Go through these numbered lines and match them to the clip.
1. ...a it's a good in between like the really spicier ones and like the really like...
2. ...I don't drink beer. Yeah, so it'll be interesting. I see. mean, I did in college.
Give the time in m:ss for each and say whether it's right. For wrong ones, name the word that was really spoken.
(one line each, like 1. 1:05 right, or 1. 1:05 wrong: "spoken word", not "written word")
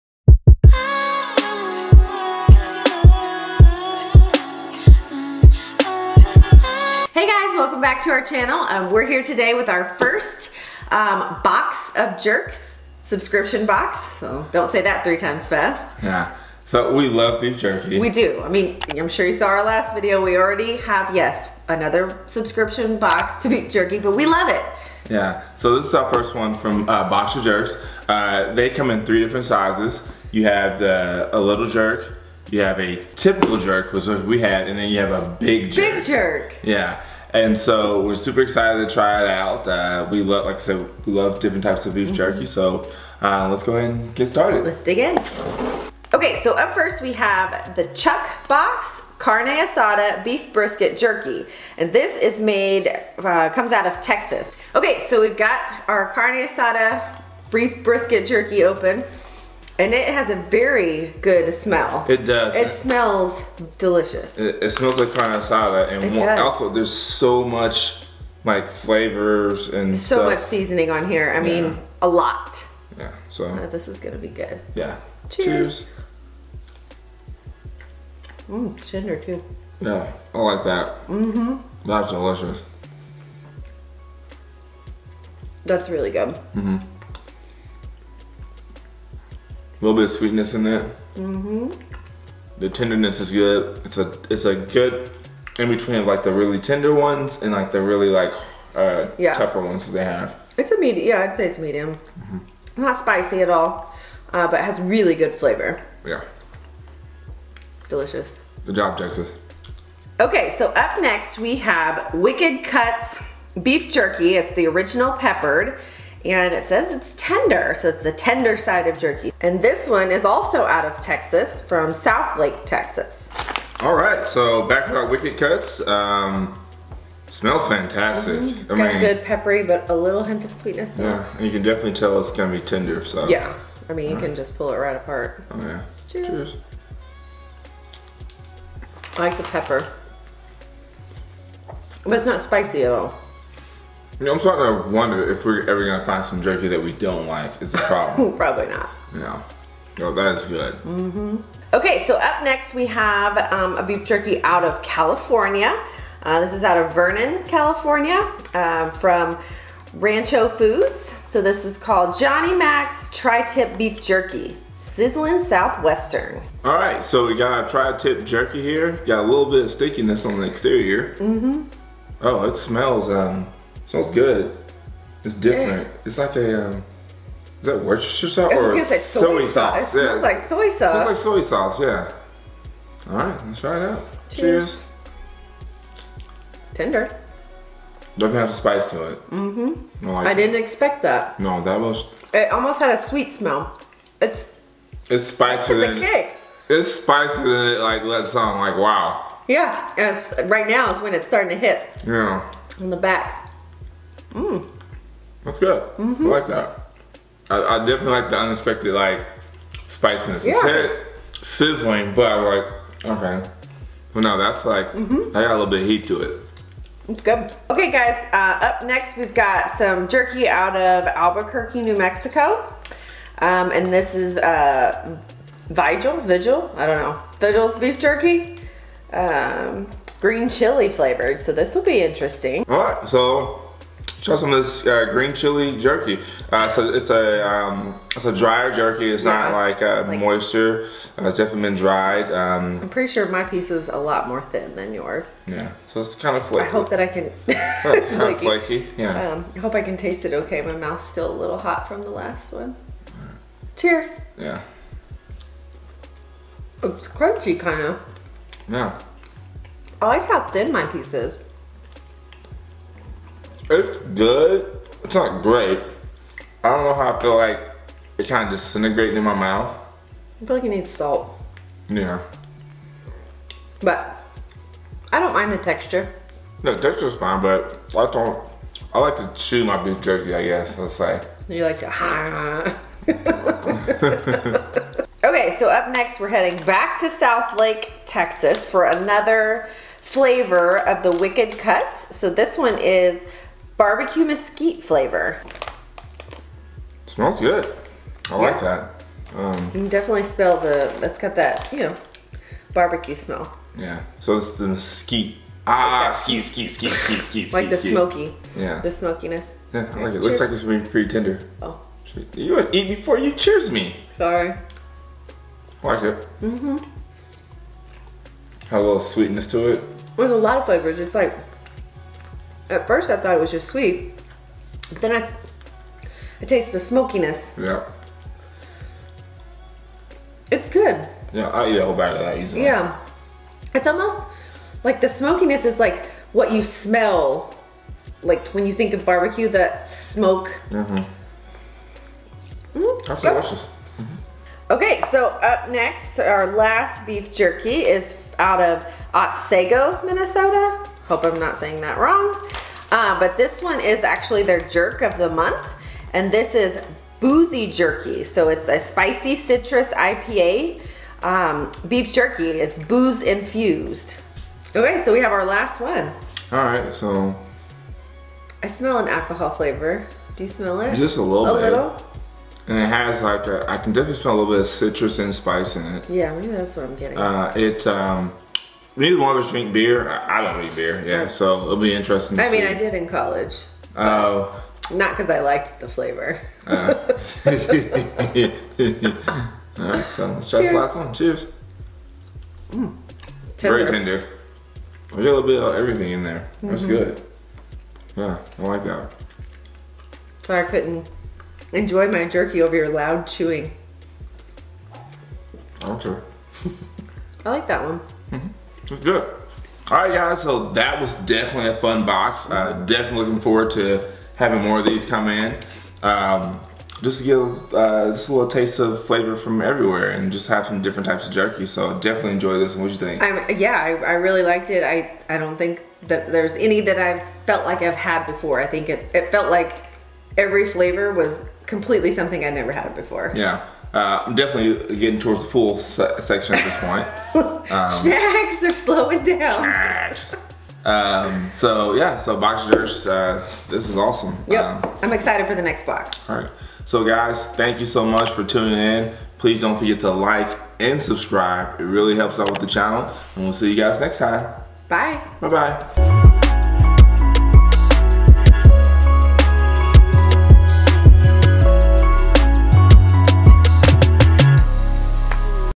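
1. 1:33 wrong: "tender", not "spicier"
2. 6:20 right.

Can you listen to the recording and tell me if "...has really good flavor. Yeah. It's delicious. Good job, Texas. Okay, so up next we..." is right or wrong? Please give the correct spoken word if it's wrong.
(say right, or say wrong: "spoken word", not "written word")
right.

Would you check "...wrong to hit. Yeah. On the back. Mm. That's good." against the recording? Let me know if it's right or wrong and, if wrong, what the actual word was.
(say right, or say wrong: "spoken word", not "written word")
wrong: "starting", not "wrong".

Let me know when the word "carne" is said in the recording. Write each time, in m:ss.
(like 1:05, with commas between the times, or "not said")
0:49, 0:56, 1:05.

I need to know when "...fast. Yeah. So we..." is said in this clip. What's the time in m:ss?
0:15.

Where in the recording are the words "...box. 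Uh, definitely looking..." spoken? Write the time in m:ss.
6:52.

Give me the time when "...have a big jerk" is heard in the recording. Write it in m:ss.
0:34.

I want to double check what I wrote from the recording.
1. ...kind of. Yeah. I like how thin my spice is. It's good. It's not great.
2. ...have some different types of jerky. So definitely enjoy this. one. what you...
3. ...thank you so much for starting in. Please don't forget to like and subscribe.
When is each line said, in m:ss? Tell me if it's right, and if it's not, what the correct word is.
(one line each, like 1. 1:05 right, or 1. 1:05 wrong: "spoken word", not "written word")
1. 4:17 wrong: "piece", not "spice"
2. 7:00 right
3. 7:27 wrong: "tuning", not "starting".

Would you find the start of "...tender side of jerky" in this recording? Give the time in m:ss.
1:58.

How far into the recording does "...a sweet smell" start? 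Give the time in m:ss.
3:12.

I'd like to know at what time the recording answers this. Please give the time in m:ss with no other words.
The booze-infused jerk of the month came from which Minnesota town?
5:49.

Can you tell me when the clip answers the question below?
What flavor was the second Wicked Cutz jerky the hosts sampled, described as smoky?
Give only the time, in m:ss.
4:53.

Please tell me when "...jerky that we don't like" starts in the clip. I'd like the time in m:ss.
2:26.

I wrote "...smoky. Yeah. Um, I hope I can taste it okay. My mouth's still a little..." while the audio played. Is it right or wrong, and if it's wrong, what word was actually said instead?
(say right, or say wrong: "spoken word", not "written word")
wrong: "flaky", not "smoky".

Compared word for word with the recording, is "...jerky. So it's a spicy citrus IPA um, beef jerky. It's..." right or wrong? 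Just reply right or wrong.
right.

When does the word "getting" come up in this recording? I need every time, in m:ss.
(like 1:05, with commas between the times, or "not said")
6:16, 7:14.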